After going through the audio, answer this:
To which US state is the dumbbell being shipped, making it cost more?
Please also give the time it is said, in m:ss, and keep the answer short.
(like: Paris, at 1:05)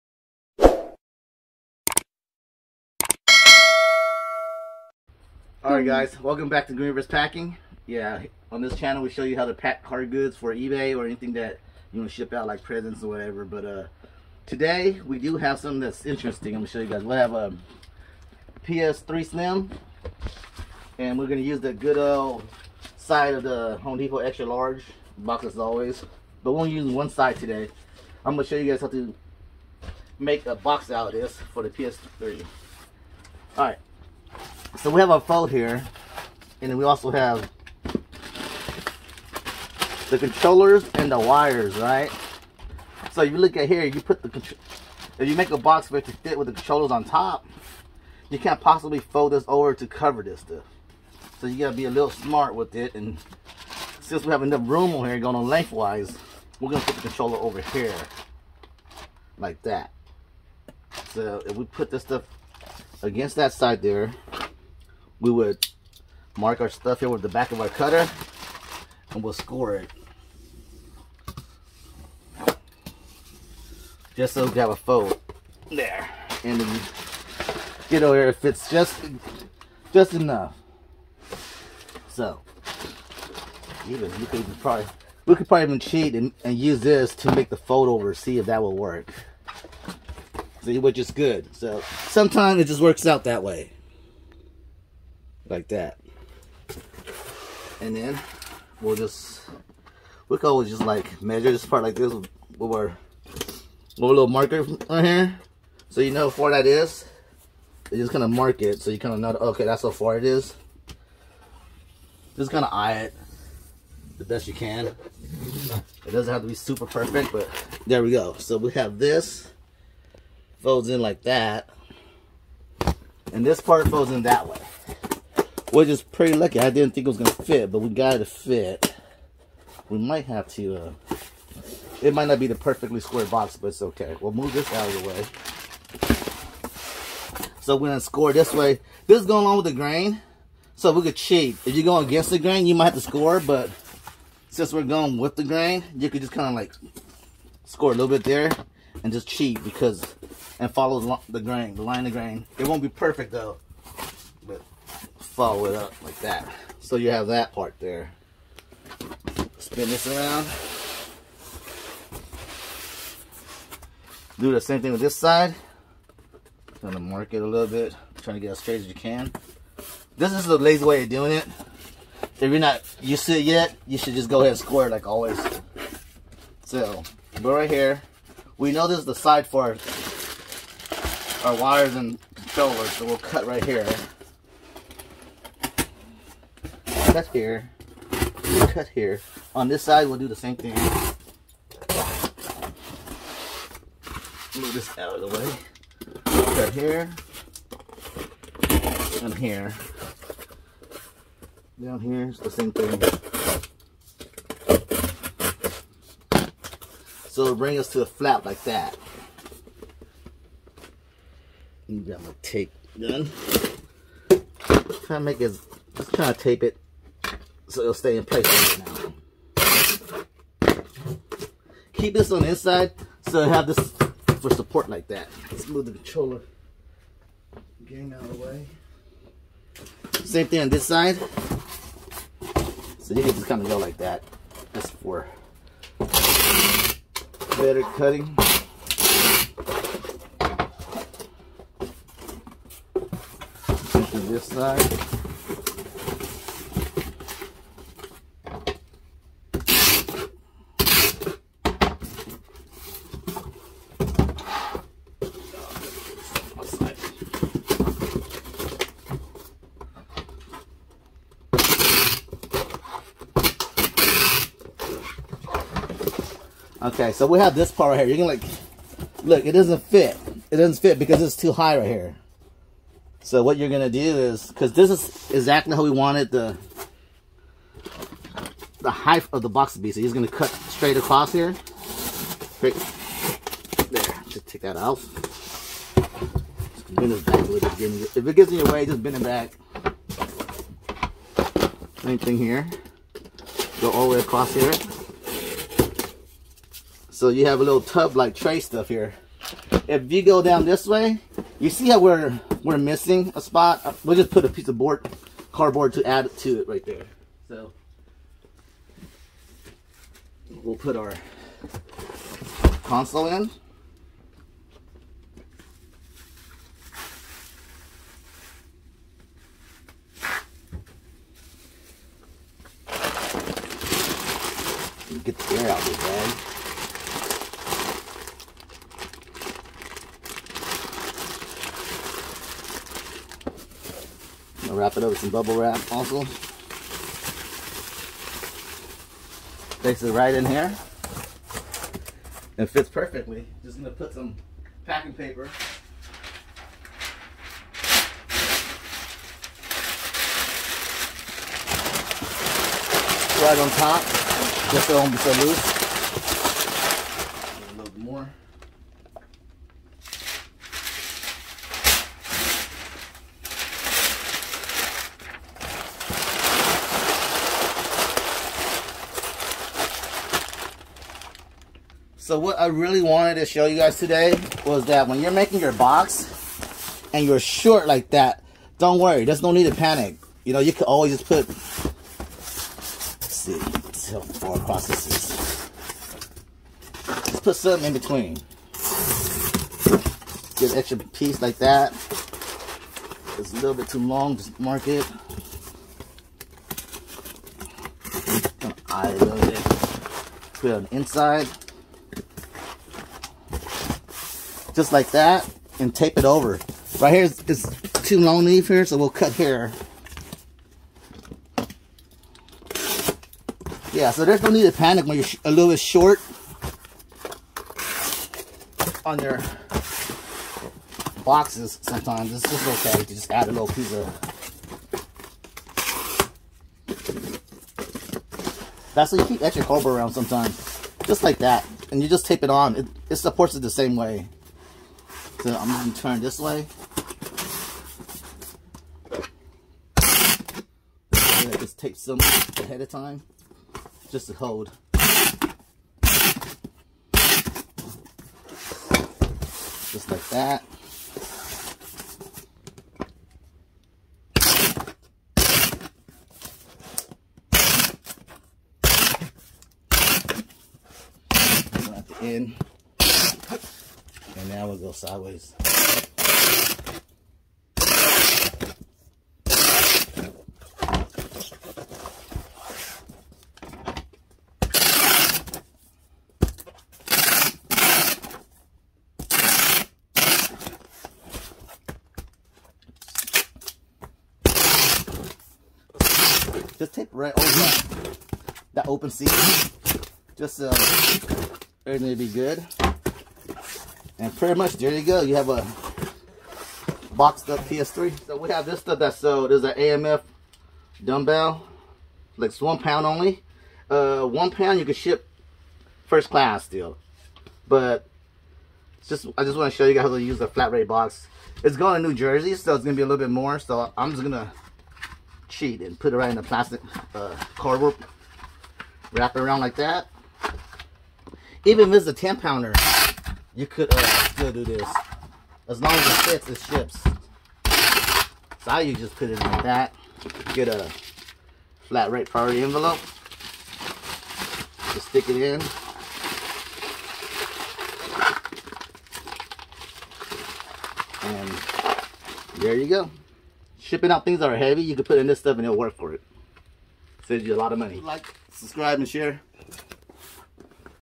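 New Jersey, at 8:32.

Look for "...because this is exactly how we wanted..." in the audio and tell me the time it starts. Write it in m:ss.
4:34.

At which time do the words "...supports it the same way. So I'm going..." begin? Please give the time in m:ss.
7:13.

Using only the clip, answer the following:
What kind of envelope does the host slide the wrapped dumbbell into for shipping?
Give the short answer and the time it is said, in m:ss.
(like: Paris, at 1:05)
flat rate priority envelope, at 8:51.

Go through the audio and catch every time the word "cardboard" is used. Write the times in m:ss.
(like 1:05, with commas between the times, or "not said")
5:05, 8:37.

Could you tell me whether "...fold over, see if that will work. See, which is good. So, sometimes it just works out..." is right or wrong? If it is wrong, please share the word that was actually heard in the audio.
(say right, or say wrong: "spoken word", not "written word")
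right.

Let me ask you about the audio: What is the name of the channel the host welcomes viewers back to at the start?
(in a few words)
Greenverse Packing.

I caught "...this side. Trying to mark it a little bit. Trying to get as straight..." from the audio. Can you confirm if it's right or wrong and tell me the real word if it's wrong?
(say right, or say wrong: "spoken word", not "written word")
right.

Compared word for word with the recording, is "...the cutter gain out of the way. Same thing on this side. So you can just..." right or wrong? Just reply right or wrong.
wrong.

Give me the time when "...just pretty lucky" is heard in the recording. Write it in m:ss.
2:05.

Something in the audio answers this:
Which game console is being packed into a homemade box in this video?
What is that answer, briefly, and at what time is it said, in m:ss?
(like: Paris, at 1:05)
PS3 Slim, at 0:18.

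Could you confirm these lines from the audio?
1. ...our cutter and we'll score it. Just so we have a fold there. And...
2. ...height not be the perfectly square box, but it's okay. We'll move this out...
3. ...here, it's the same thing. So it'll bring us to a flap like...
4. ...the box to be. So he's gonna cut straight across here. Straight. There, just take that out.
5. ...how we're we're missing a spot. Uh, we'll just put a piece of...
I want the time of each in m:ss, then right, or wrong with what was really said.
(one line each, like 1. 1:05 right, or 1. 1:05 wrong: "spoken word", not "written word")
1. 1:07 right
2. 2:12 wrong: "might", not "height"
3. 3:21 right
4. 4:39 right
5. 5:01 right.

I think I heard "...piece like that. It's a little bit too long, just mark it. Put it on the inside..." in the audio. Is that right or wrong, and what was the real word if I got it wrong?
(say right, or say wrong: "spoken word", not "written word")
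right.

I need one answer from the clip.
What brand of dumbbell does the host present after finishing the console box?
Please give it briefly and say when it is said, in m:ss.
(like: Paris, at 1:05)
AMF, at 8:19.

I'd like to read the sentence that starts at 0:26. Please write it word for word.
But we're only using one side today.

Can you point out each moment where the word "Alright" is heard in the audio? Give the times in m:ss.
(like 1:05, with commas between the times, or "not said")
0:05, 0:33.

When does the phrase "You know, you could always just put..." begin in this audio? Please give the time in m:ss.
6:20.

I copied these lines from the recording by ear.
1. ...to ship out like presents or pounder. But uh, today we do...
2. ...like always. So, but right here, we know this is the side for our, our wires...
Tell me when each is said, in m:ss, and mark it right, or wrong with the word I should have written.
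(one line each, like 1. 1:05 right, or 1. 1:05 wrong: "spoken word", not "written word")
1. 0:12 wrong: "whatever", not "pounder"
2. 2:54 right.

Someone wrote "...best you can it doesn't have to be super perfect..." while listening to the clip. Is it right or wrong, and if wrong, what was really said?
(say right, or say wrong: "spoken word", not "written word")
right.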